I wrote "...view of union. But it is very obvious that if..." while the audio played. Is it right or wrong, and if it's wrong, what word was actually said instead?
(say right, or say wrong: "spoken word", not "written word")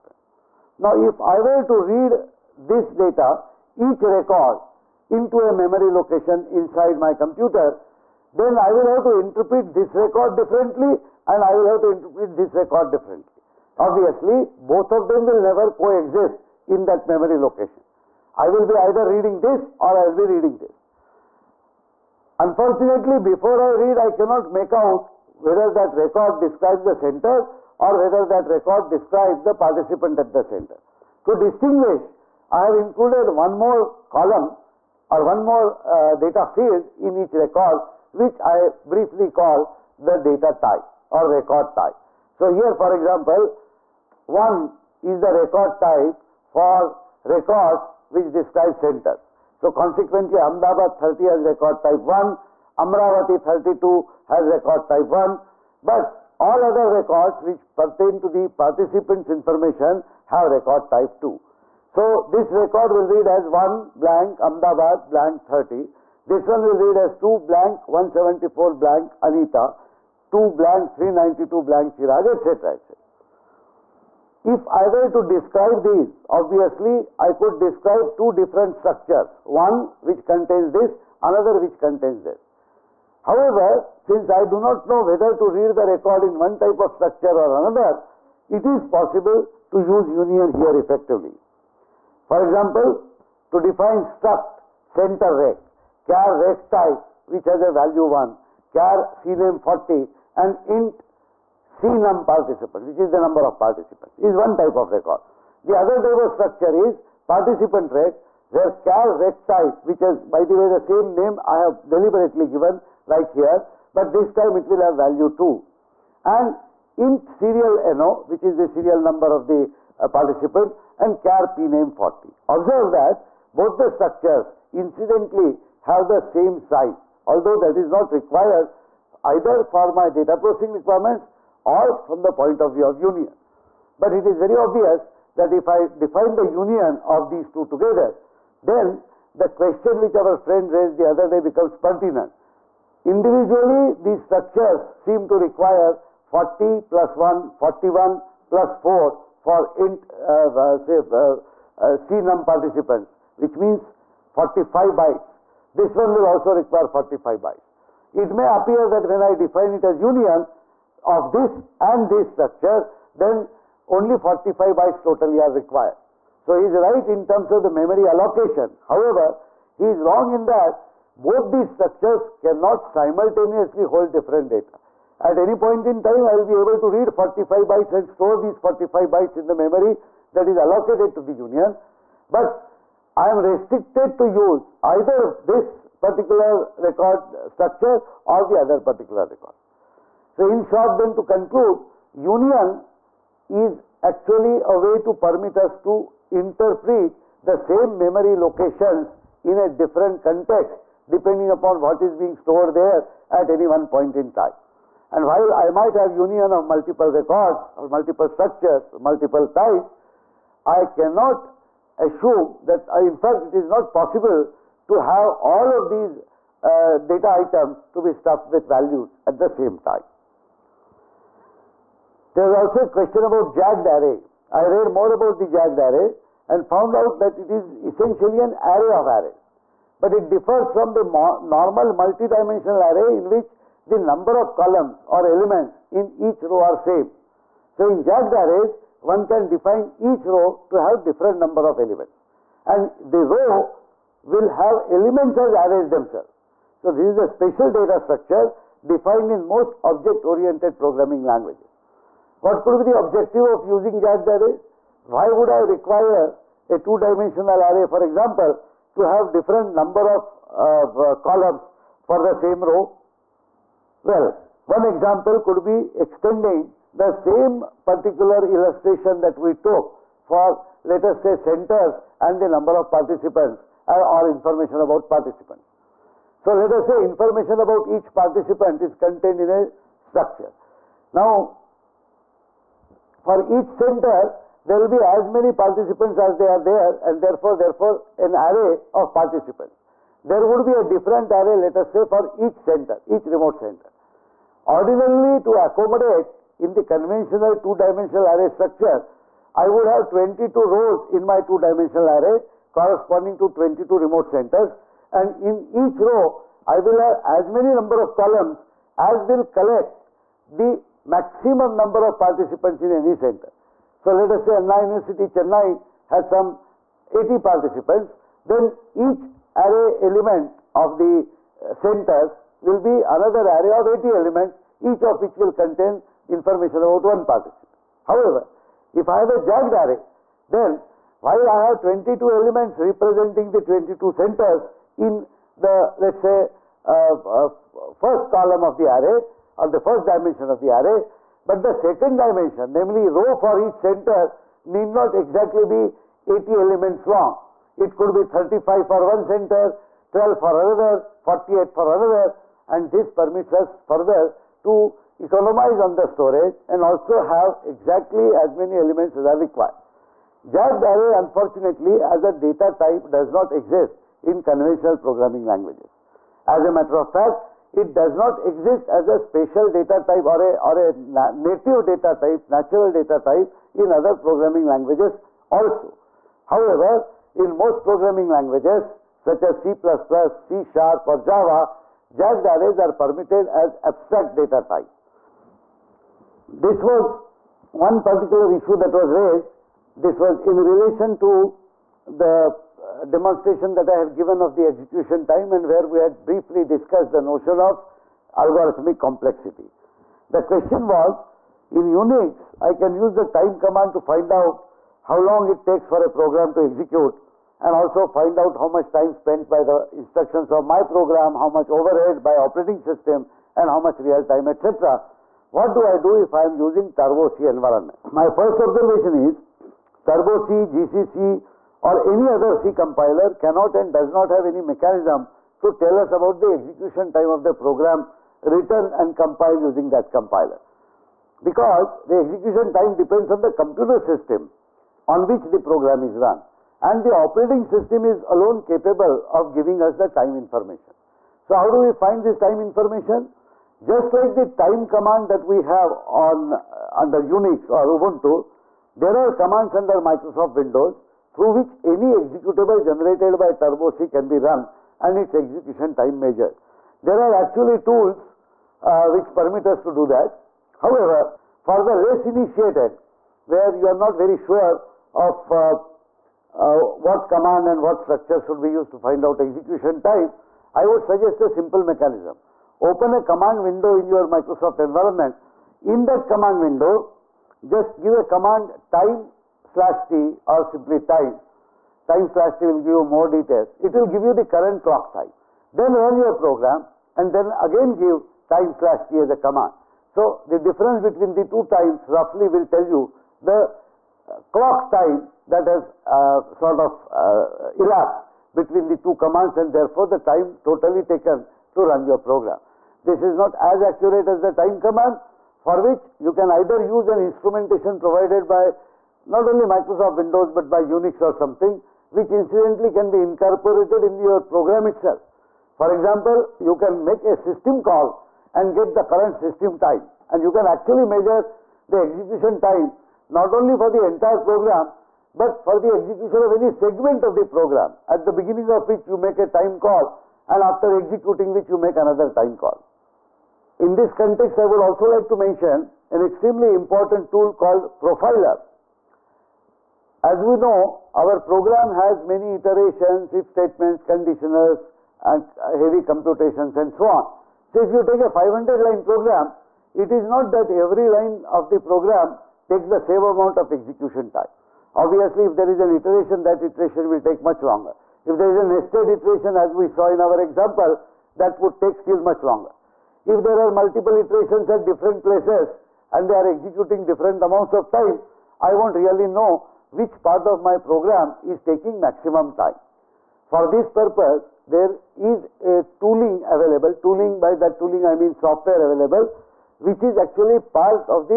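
right.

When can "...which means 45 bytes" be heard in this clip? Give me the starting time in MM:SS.
02:33.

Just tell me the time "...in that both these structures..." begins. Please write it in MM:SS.
02:50.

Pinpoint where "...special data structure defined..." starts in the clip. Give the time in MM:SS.
04:07.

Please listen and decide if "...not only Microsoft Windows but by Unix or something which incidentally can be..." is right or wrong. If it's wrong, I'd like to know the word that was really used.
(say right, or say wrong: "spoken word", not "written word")
right.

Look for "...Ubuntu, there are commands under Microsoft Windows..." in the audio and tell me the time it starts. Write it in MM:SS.
07:27.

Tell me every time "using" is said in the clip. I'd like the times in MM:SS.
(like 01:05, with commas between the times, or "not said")
04:13, 06:56, 07:09.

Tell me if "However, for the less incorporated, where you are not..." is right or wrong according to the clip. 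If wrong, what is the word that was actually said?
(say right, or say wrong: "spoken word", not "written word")
wrong: "initiated", not "incorporated".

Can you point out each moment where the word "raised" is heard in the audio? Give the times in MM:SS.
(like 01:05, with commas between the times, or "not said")
02:20, 06:29.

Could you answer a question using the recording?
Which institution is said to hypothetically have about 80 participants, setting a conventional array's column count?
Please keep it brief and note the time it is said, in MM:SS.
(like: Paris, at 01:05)
Anna University Chennai, at 05:14.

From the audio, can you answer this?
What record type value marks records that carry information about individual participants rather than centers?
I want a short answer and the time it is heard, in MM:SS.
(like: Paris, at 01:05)
2, at 01:00.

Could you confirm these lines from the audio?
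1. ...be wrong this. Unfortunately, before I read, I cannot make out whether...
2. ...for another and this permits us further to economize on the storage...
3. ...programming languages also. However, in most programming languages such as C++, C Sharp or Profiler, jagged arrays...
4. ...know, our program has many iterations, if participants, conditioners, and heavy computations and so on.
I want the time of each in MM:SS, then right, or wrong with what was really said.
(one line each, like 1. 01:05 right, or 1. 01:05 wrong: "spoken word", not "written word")
1. 00:20 wrong: "reading", not "wrong"
2. 05:51 right
3. 06:14 wrong: "Java", not "Profiler"
4. 09:00 wrong: "statements", not "participants".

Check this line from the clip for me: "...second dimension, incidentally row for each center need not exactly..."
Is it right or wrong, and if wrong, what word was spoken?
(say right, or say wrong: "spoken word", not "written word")
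wrong: "namely", not "incidentally".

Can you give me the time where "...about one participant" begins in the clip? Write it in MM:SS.
05:26.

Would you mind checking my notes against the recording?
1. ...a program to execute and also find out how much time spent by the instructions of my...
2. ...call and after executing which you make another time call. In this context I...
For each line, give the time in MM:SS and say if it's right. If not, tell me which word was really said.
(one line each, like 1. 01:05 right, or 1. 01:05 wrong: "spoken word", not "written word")
1. 06:46 right
2. 08:49 right.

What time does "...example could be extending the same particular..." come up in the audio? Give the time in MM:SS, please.
04:24.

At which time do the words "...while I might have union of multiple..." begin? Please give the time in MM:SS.
03:25.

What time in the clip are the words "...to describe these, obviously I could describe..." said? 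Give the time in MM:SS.
01:15.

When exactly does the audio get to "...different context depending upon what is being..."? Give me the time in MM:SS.
03:19.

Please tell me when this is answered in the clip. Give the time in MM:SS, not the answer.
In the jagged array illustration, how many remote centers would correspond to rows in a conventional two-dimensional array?
05:00.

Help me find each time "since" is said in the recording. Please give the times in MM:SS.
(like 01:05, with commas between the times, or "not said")
01:23.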